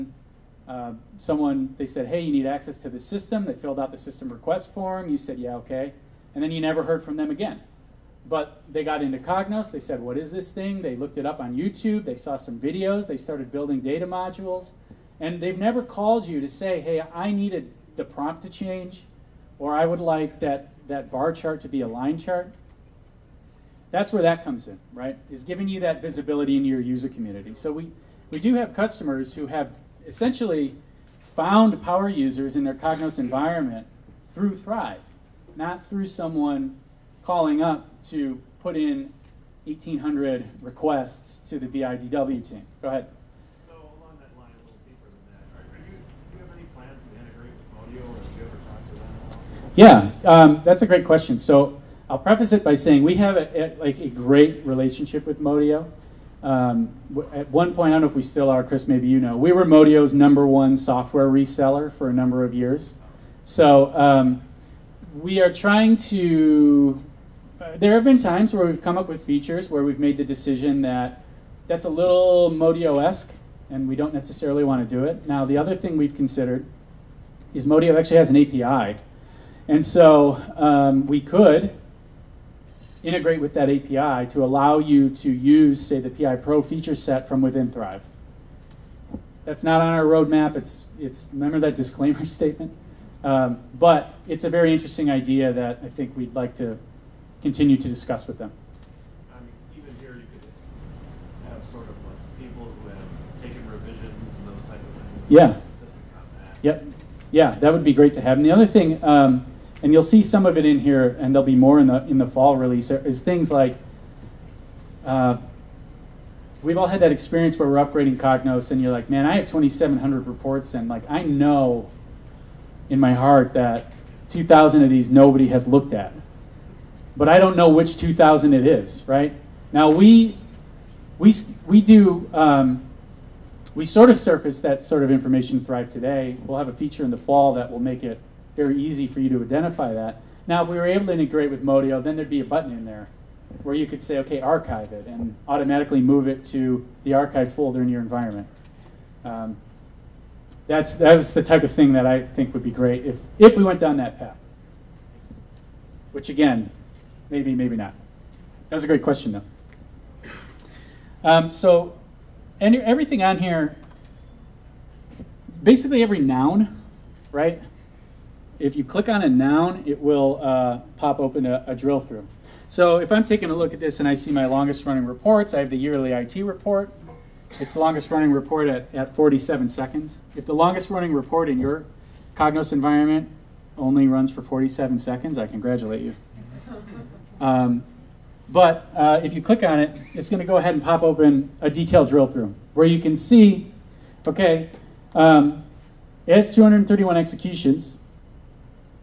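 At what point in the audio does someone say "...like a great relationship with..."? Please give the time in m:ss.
0:53.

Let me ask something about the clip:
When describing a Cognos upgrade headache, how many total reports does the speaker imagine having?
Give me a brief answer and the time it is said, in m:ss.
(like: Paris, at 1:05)
2,700, at 1:59.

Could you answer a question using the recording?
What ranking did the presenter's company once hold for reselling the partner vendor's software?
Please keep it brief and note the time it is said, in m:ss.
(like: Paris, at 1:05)
number one software reseller, at 1:00.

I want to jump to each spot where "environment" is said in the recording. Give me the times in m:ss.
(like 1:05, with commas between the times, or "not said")
0:33, 2:28, 3:02.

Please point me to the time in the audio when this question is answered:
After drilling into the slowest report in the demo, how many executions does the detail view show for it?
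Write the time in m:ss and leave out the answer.
3:16.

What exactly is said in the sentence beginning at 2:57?
It's the longest running report at, at 47 seconds.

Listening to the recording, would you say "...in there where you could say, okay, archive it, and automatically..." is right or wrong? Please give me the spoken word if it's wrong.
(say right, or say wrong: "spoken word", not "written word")
right.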